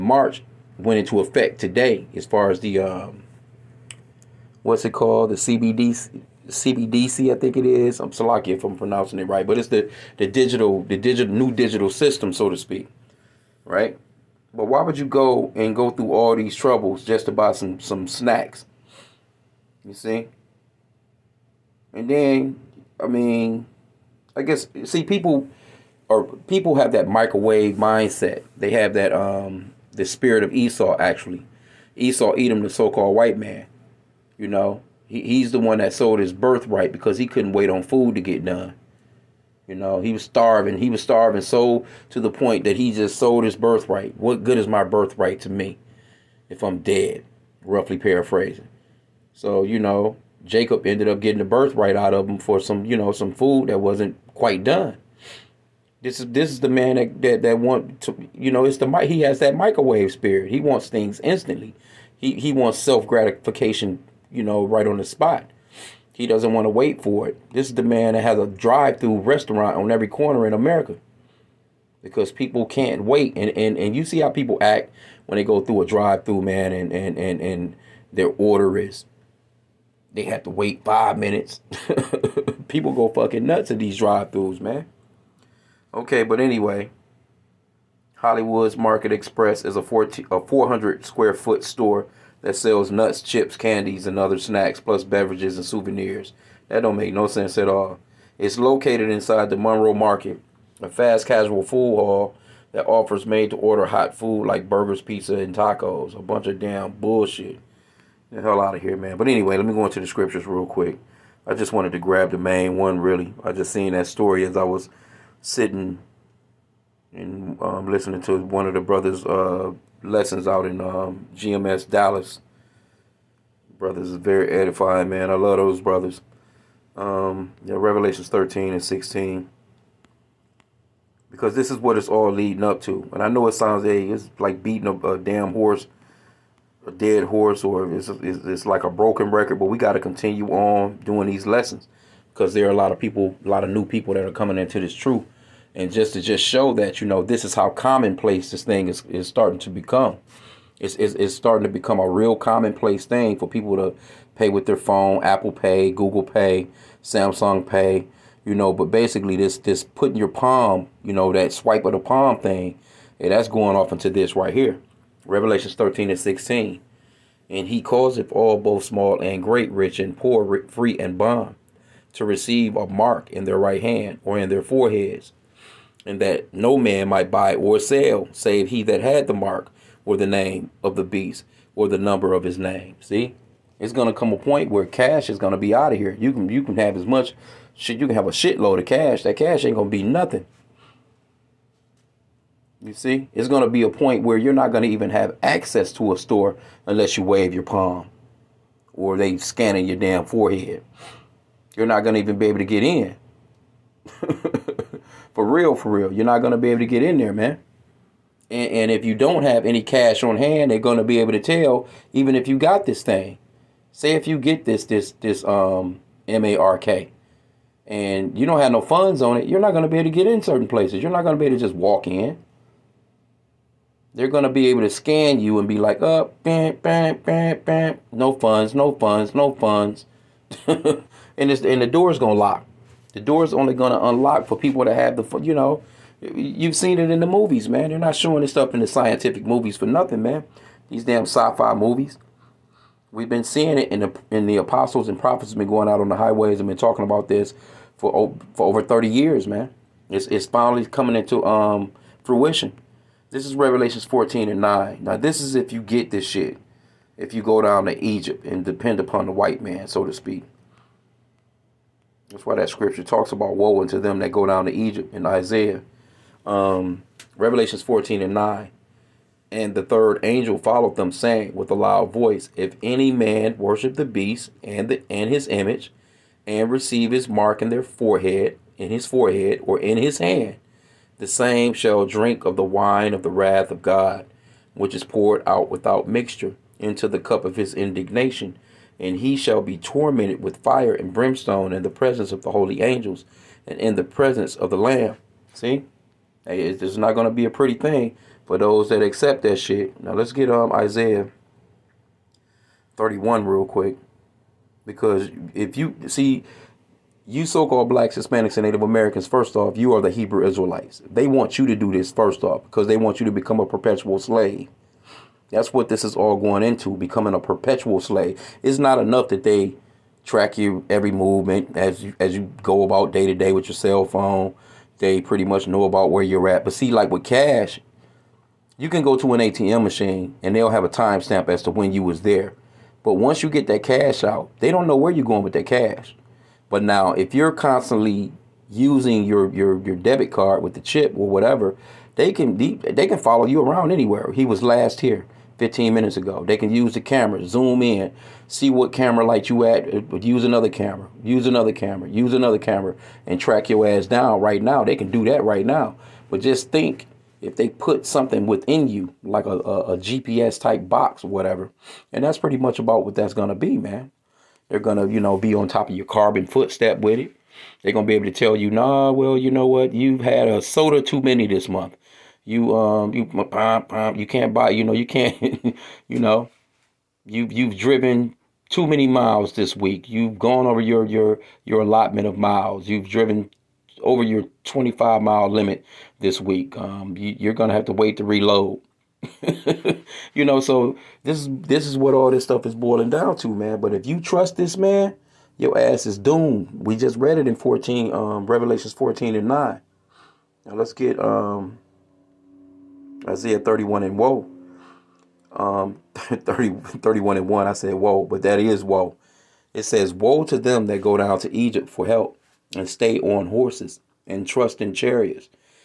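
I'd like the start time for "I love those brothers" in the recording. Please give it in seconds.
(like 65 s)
125 s.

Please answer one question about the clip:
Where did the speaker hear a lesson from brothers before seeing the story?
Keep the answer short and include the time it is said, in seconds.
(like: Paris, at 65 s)
GMS Dallas, at 121 s.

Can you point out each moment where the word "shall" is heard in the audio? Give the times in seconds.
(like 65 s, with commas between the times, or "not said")
281 s, 289 s.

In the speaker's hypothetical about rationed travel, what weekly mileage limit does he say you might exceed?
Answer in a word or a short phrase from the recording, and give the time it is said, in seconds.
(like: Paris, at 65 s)
25 miles, at 384 s.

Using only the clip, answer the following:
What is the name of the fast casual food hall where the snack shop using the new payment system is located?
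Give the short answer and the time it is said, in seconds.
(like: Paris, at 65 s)
Monroe Market, at 99 s.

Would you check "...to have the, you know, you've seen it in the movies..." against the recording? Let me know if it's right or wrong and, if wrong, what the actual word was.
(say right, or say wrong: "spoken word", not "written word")
right.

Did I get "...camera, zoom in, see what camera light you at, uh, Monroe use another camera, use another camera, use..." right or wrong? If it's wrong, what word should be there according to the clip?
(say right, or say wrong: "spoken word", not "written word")
wrong: "But", not "Monroe".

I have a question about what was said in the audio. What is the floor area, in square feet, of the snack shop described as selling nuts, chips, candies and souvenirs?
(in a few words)
400.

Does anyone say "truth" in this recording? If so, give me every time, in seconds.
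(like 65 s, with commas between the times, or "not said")
144 s.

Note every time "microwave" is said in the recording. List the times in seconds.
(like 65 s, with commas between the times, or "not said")
27 s, 59 s.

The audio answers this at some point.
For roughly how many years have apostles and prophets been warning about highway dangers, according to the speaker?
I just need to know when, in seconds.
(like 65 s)
248 s.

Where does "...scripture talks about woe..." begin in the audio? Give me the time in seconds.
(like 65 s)
262 s.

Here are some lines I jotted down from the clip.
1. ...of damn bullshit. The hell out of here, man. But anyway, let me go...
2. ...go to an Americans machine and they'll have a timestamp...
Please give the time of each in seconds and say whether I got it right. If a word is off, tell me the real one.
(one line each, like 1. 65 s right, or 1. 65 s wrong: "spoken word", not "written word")
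1. 106 s right
2. 329 s wrong: "ATM", not "Americans".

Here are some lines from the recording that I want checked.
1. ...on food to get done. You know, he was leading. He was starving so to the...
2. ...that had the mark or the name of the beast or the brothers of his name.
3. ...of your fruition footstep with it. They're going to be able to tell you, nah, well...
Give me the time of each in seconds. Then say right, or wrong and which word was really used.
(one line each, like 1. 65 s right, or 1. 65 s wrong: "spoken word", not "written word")
1. 37 s wrong: "starving", not "leading"
2. 178 s wrong: "number", not "brothers"
3. 365 s wrong: "carbon", not "fruition".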